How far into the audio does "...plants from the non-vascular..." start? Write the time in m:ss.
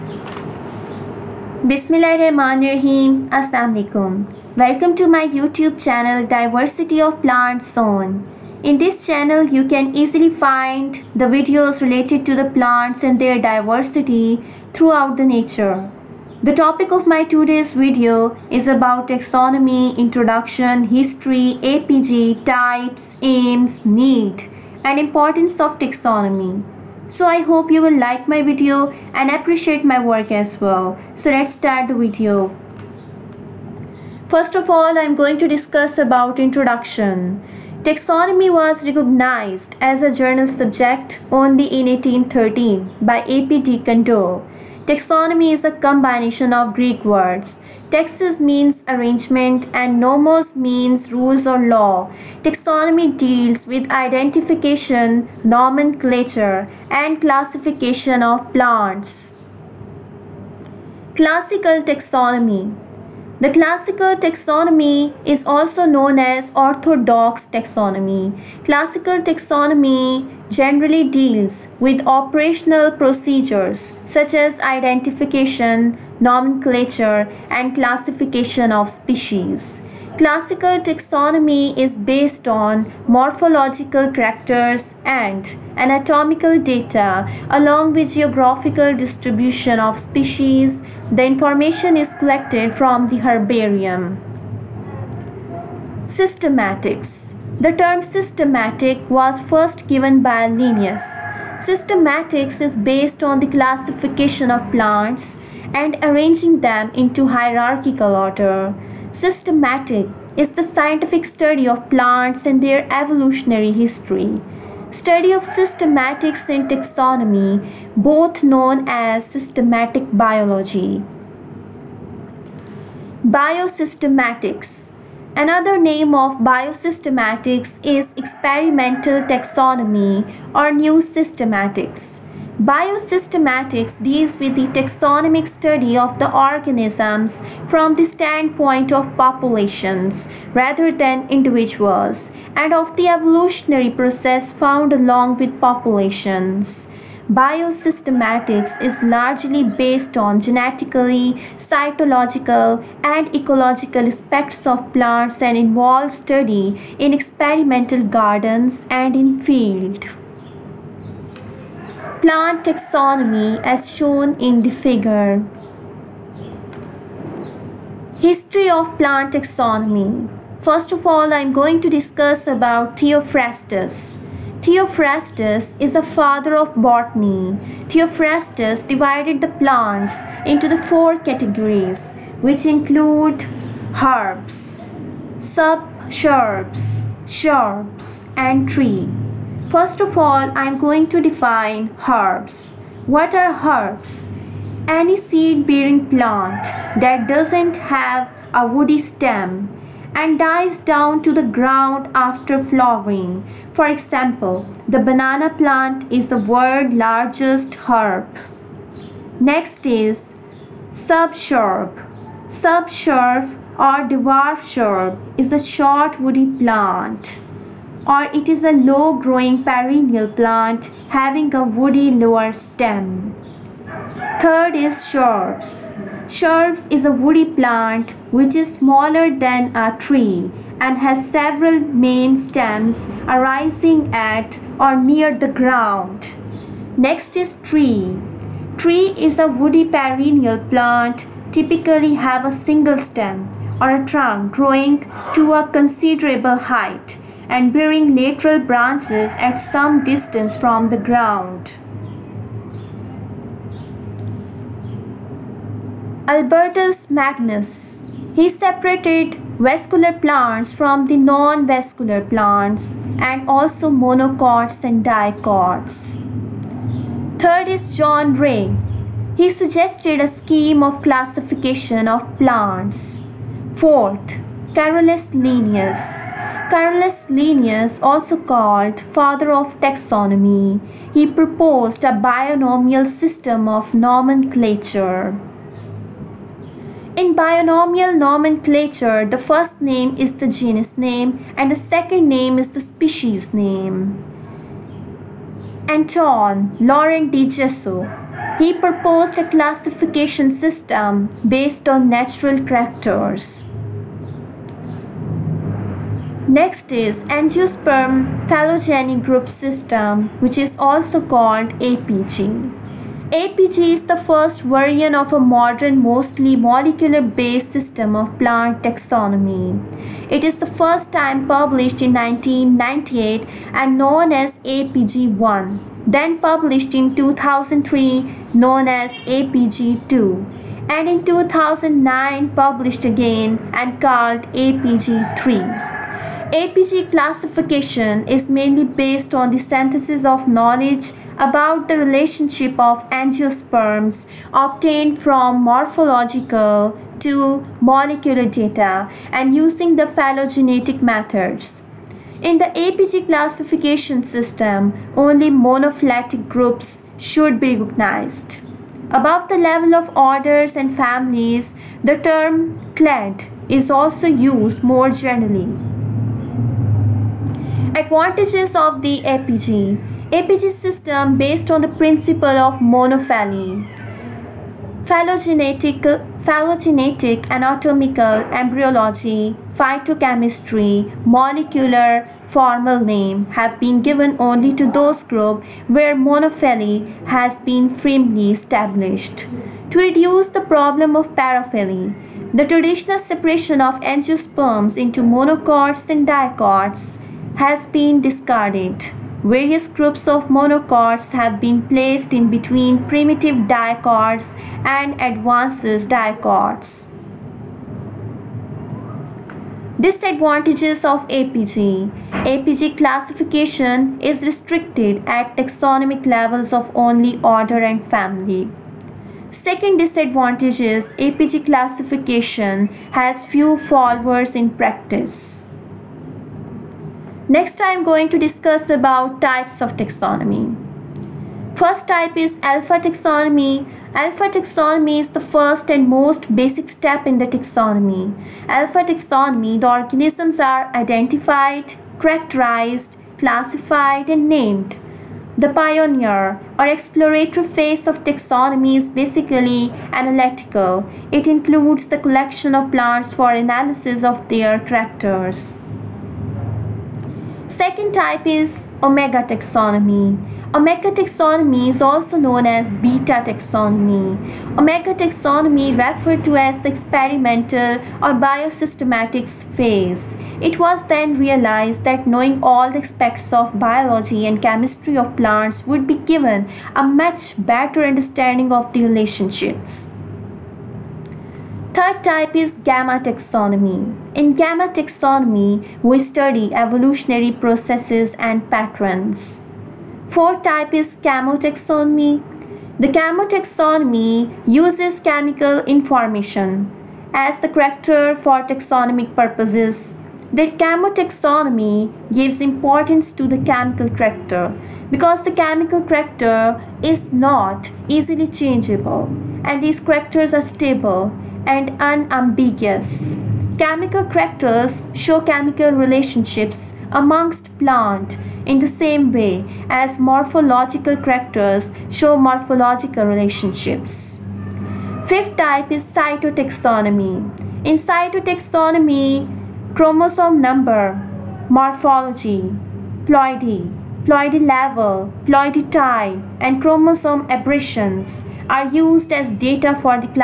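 4:20.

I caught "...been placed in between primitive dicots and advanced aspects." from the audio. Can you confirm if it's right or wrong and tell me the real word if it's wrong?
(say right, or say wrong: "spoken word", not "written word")
wrong: "dicots", not "aspects".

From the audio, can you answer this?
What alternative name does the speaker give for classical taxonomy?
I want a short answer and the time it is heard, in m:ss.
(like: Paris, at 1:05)
Orthodox taxonomy, at 1:06.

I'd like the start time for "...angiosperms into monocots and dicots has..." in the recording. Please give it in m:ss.
6:34.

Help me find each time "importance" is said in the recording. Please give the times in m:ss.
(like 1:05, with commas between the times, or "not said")
0:25, 8:22.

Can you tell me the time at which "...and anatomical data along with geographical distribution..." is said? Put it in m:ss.
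1:25.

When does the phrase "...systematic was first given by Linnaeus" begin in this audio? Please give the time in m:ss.
1:38.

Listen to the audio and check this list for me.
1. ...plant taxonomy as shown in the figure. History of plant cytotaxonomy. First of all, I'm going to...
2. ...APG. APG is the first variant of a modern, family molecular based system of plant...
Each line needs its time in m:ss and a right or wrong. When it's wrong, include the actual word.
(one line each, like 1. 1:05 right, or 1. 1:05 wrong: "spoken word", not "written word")
1. 2:42 wrong: "taxonomy", not "cytotaxonomy"
2. 5:11 wrong: "mostly", not "family".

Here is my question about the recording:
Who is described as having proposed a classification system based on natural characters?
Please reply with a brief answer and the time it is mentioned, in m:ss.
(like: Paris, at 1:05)
Anton Laurent de Jussieu, at 4:55.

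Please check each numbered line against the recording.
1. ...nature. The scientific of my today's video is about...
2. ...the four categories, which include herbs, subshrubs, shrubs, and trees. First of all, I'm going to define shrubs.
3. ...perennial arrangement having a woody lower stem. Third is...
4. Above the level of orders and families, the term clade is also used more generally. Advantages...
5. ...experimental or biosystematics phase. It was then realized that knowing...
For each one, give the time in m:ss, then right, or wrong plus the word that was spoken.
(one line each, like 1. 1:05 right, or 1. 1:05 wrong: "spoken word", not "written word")
1. 0:15 wrong: "topic", not "scientific"
2. 3:00 wrong: "herbs", not "shrubs"
3. 3:39 wrong: "plant", not "arrangement"
4. 5:59 right
5. 7:46 right.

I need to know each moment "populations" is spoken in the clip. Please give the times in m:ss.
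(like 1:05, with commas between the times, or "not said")
2:19, 2:25.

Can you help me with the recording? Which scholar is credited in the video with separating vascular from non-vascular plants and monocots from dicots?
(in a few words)
Albertus Magnus.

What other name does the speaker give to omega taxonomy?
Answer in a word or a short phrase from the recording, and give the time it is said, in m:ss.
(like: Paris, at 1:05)
Beta taxonomy, at 7:43.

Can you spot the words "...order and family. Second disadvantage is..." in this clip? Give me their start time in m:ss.
6:57.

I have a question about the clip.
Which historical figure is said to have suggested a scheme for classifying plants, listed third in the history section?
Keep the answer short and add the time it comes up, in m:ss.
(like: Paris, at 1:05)
John Ray, at 4:27.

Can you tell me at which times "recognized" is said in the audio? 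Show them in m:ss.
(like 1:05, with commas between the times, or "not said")
0:38, 5:57.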